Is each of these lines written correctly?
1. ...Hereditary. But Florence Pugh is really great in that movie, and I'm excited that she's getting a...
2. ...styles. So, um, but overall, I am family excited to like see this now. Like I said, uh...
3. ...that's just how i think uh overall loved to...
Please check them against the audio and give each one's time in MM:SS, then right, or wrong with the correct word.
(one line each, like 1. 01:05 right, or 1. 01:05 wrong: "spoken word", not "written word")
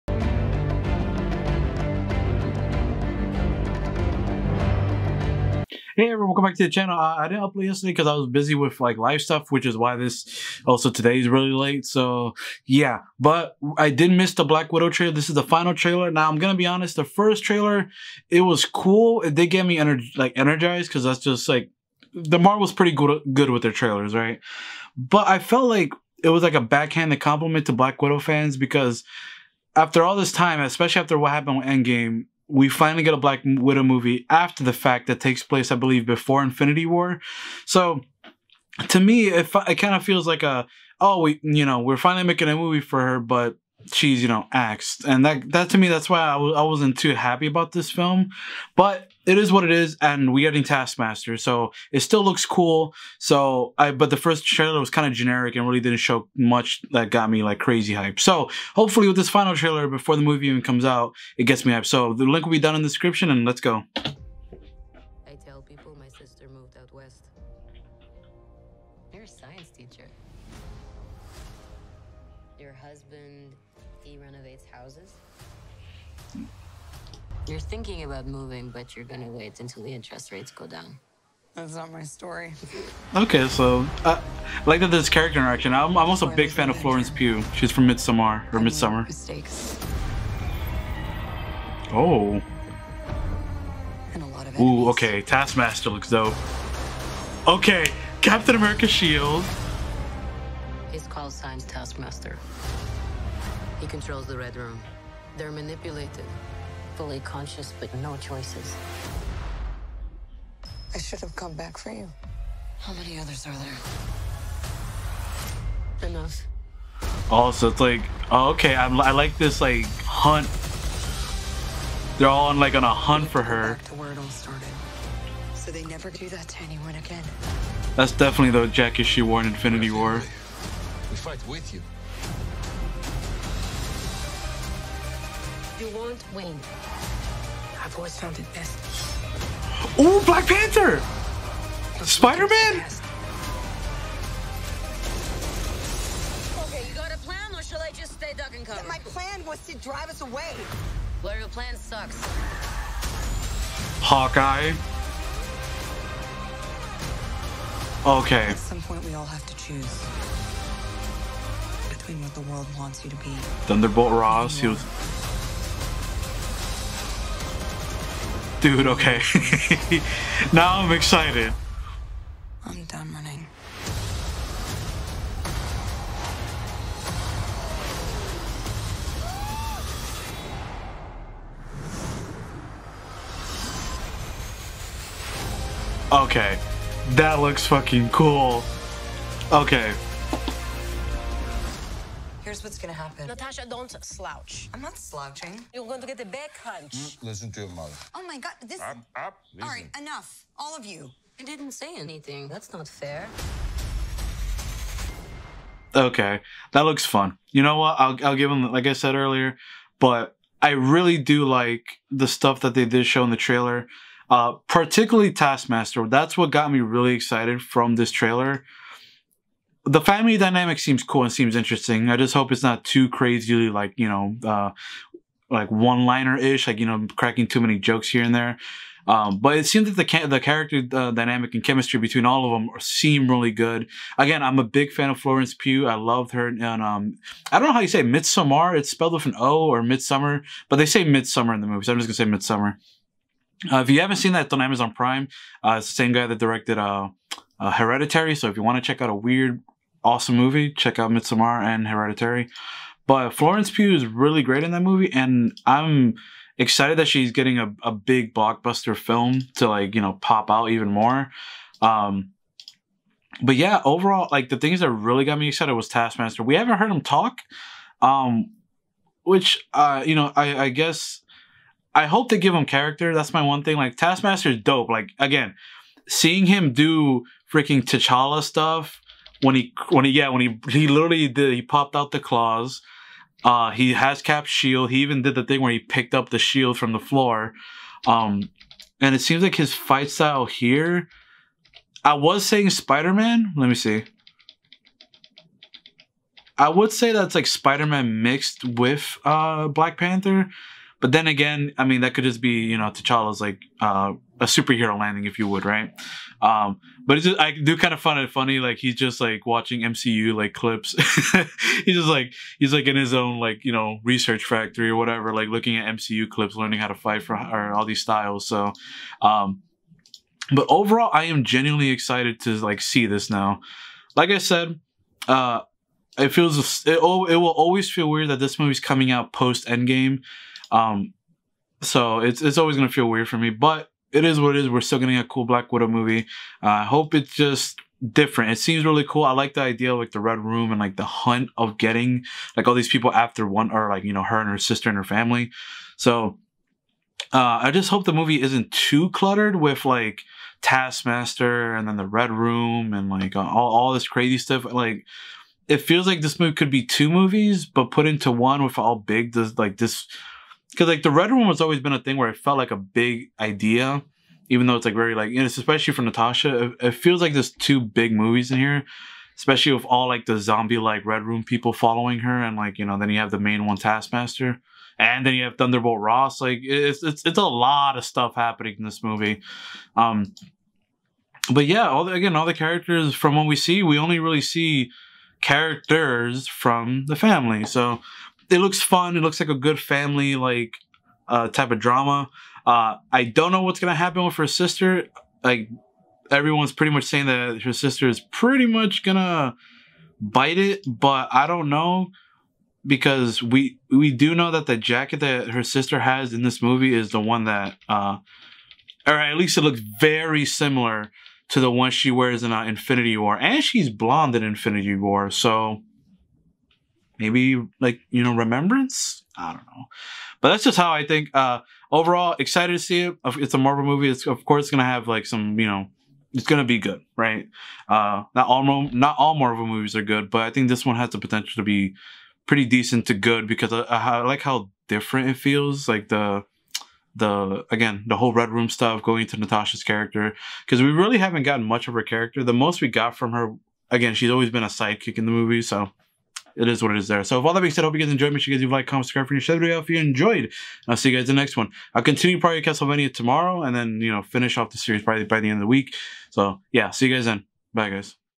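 1. 04:11 right
2. 05:18 wrong: "genuinely", not "family"
3. 07:00 wrong: "excited", not "loved".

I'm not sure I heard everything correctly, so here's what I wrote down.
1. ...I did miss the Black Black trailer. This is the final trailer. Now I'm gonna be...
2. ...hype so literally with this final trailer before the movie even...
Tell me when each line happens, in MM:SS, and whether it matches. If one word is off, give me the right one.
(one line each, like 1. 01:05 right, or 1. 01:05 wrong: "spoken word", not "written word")
1. 00:13 wrong: "Widow", not "Black"
2. 00:57 wrong: "hopefully", not "literally".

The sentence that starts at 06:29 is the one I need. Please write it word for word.
It looks like a good family like uh, type of drama.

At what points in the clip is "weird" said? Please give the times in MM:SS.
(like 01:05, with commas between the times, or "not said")
04:09, 05:28, 05:33.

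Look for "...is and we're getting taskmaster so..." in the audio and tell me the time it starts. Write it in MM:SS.
00:49.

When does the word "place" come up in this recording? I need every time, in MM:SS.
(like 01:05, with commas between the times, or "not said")
00:35.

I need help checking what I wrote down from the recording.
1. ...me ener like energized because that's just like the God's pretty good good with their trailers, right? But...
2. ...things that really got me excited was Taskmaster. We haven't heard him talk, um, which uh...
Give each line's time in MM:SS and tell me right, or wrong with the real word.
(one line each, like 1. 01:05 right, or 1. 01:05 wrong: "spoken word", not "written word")
1. 00:19 wrong: "Marvel", not "God"
2. 04:24 right.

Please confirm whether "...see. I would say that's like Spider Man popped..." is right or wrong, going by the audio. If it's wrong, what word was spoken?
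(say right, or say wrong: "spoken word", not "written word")
wrong: "mixed", not "popped".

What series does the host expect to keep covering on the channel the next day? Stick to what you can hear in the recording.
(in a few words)
Castlevania.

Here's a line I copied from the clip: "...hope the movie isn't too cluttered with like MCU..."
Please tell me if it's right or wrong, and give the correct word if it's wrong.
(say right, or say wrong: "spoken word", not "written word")
wrong: "Taskmaster", not "MCU".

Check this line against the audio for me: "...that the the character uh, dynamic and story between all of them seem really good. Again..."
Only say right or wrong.
wrong.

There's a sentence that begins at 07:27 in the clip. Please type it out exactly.
So with all that being said, I hope you guys enjoyed.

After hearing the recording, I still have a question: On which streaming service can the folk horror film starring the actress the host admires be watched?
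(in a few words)
Amazon Prime.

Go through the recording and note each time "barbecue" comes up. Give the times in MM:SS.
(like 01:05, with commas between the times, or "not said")
not said.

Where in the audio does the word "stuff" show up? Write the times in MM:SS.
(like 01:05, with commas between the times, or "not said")
00:09, 03:32, 04:38, 05:54, 06:18, 07:18.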